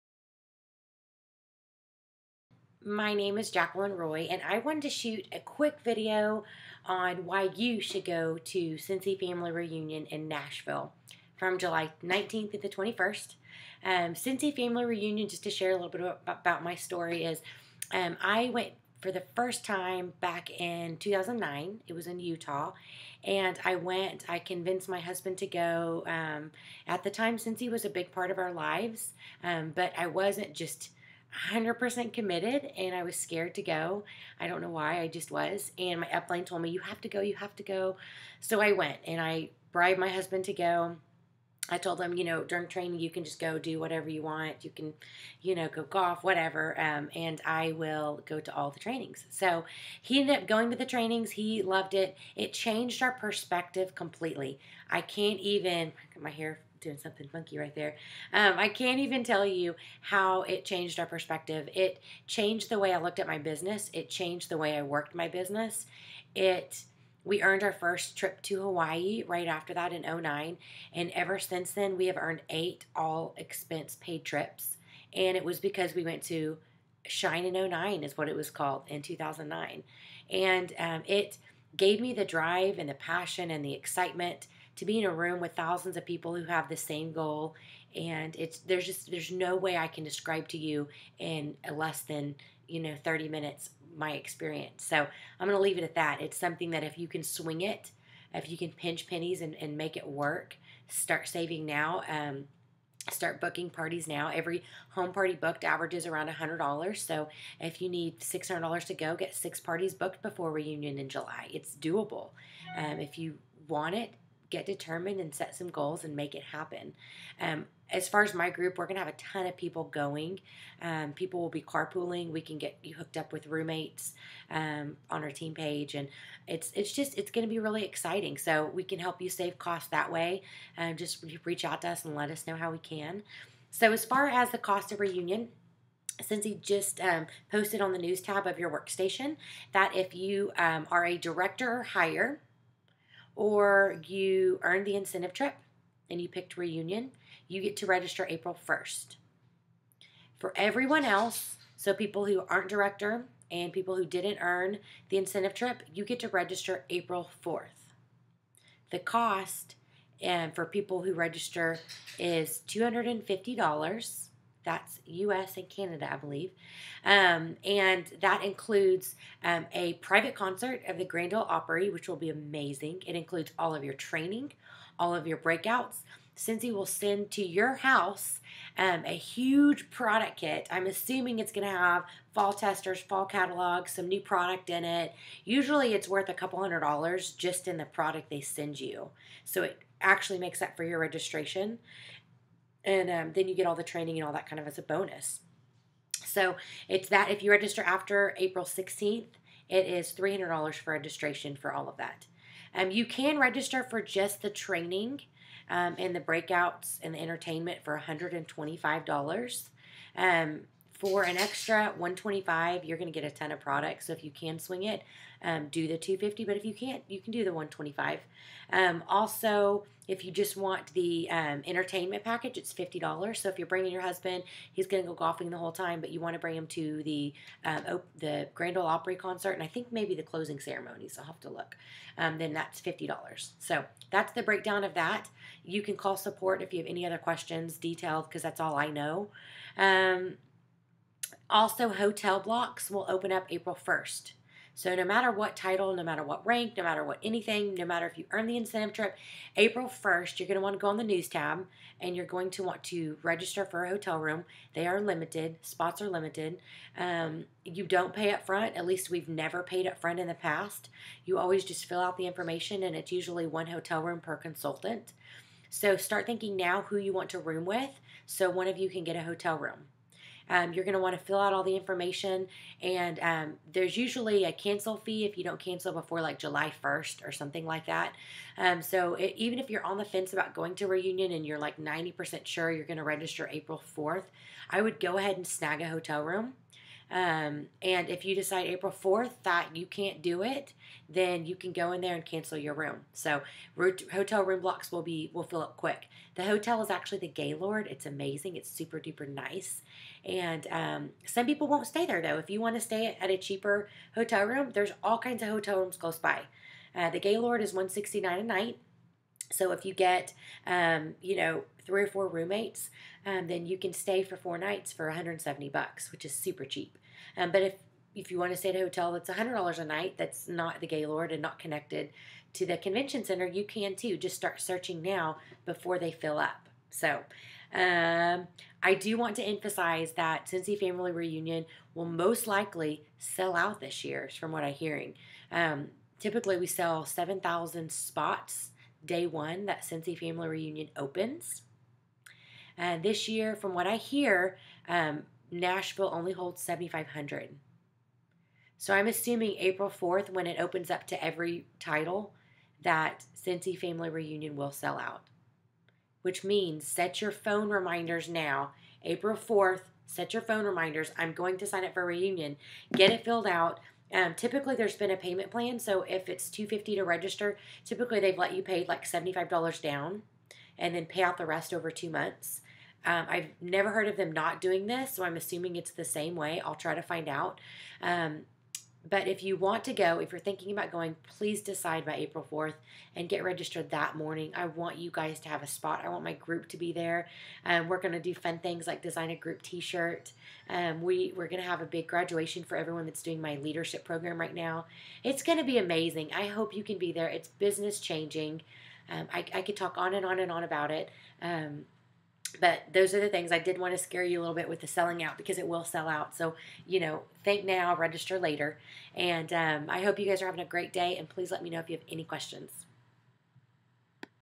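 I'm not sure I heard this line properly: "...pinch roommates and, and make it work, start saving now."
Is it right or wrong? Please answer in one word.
wrong.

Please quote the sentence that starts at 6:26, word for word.
I want my group to be there.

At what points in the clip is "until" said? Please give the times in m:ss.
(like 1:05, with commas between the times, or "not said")
not said.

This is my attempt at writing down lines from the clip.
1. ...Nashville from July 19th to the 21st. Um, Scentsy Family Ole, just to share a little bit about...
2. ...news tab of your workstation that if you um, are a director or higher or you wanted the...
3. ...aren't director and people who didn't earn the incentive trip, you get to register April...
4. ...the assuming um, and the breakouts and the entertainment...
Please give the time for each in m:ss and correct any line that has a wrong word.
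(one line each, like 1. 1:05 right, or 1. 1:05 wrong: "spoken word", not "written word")
1. 0:10 wrong: "Reunion", not "Ole"
2. 2:17 wrong: "earned", not "wanted"
3. 2:32 right
4. 3:24 wrong: "training", not "assuming".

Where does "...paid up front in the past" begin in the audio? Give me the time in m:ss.
4:19.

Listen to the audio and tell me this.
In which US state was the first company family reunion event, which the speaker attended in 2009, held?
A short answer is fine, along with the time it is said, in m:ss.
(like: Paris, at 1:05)
Utah, at 0:22.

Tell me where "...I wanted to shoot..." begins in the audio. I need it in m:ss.
0:04.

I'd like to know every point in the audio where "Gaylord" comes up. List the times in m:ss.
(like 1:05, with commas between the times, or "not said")
4:57, 5:07, 5:20.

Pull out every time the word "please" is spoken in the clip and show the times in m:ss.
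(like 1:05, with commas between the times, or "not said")
6:21, 6:51.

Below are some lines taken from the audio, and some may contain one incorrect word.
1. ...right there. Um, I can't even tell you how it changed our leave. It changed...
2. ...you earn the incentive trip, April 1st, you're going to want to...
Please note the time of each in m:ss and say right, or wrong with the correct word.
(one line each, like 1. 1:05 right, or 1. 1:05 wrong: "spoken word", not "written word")
1. 0:57 wrong: "perspective", not "leave"
2. 4:08 right.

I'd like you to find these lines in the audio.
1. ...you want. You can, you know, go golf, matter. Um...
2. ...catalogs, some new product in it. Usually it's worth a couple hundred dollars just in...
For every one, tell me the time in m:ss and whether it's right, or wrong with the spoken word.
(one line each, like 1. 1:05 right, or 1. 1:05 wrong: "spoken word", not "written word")
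1. 0:44 wrong: "whatever", not "matter"
2. 3:03 right.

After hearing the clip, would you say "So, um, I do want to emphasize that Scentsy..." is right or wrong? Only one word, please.
right.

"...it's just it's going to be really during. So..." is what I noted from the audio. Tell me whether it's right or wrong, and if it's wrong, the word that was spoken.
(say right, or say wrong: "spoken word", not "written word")
wrong: "exciting", not "during".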